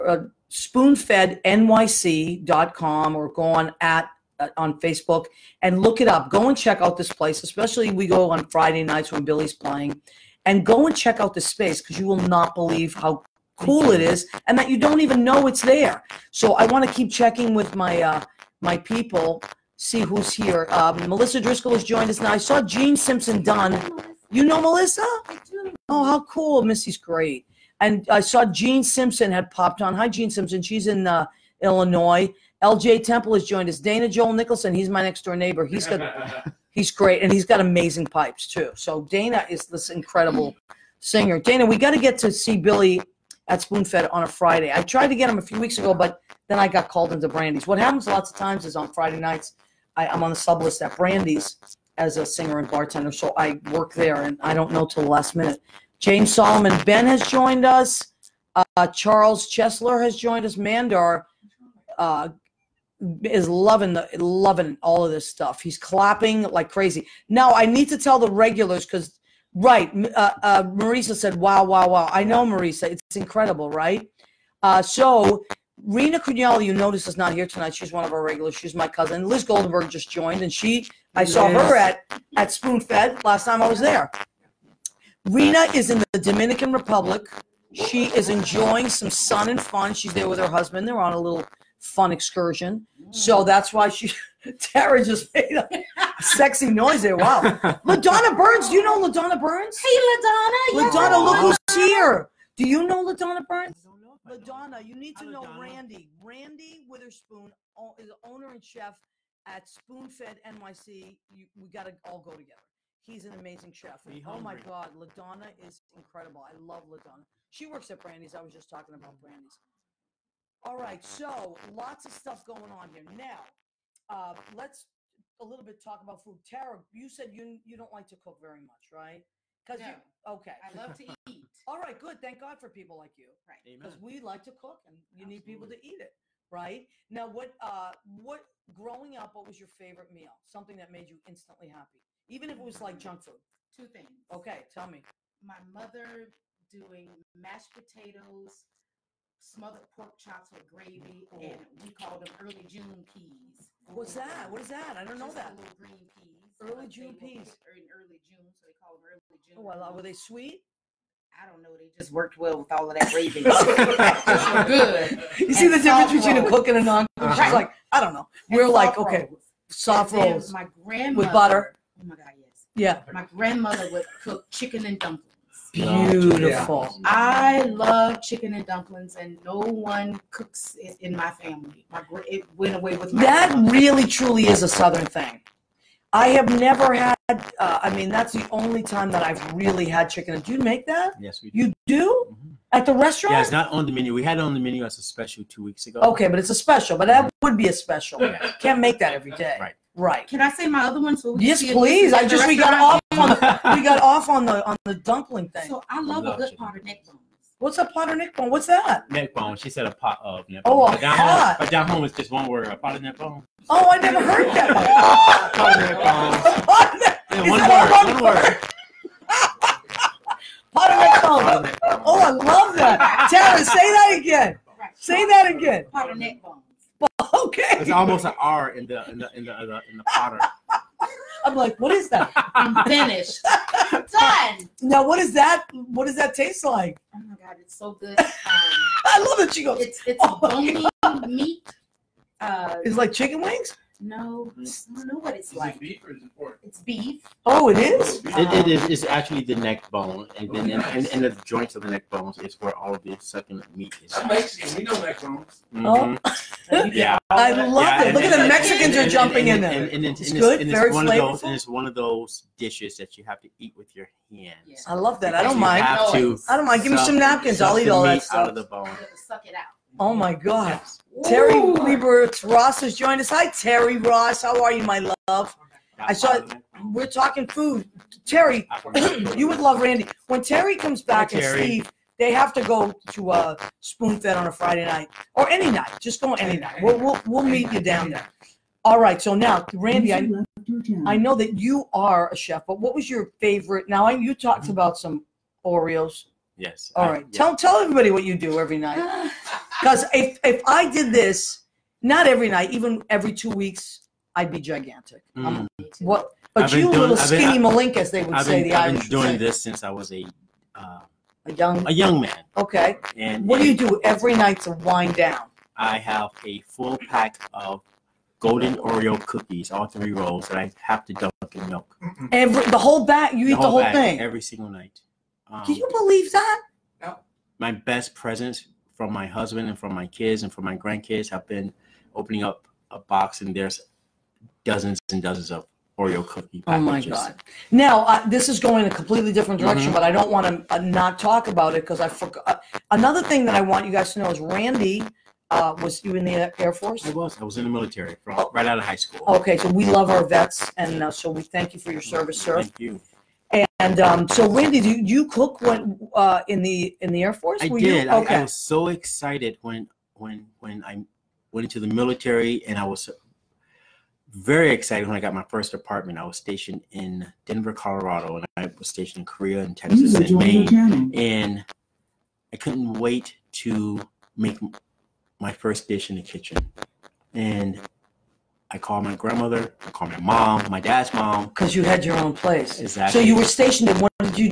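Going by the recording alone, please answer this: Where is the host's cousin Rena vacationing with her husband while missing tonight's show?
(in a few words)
Dominican Republic.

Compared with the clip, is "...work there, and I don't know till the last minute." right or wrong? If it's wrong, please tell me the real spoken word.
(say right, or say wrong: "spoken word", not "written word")
right.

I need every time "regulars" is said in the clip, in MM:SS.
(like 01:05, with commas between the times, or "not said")
01:08, 01:18.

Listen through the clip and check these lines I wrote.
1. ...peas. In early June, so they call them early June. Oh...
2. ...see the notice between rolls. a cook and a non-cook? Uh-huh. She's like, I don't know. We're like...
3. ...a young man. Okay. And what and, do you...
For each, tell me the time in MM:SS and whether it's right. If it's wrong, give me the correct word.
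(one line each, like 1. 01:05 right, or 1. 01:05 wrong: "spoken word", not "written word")
1. 02:37 right
2. 02:45 wrong: "difference", not "notice"
3. 05:11 right.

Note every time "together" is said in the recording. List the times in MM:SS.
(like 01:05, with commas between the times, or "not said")
01:52.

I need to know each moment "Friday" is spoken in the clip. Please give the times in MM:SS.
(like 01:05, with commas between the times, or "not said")
00:08, 00:44, 00:48, 04:44.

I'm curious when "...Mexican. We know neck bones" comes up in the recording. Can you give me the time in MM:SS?
04:14.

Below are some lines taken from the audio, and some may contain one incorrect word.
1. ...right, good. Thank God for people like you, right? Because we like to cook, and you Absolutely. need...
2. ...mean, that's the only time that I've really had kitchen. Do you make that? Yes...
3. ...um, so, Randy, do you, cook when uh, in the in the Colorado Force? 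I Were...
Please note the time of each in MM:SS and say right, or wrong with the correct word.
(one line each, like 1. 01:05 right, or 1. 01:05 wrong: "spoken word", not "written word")
1. 02:11 right
2. 03:07 wrong: "chicken", not "kitchen"
3. 05:53 wrong: "Air", not "Colorado".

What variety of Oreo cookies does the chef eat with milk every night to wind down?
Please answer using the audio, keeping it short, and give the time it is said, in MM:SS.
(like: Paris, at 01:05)
Golden, at 05:18.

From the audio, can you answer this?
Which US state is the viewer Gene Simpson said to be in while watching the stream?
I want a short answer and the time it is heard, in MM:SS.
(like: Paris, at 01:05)
Illinois, at 00:31.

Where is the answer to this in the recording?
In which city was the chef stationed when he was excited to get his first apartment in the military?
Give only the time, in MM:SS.
06:07.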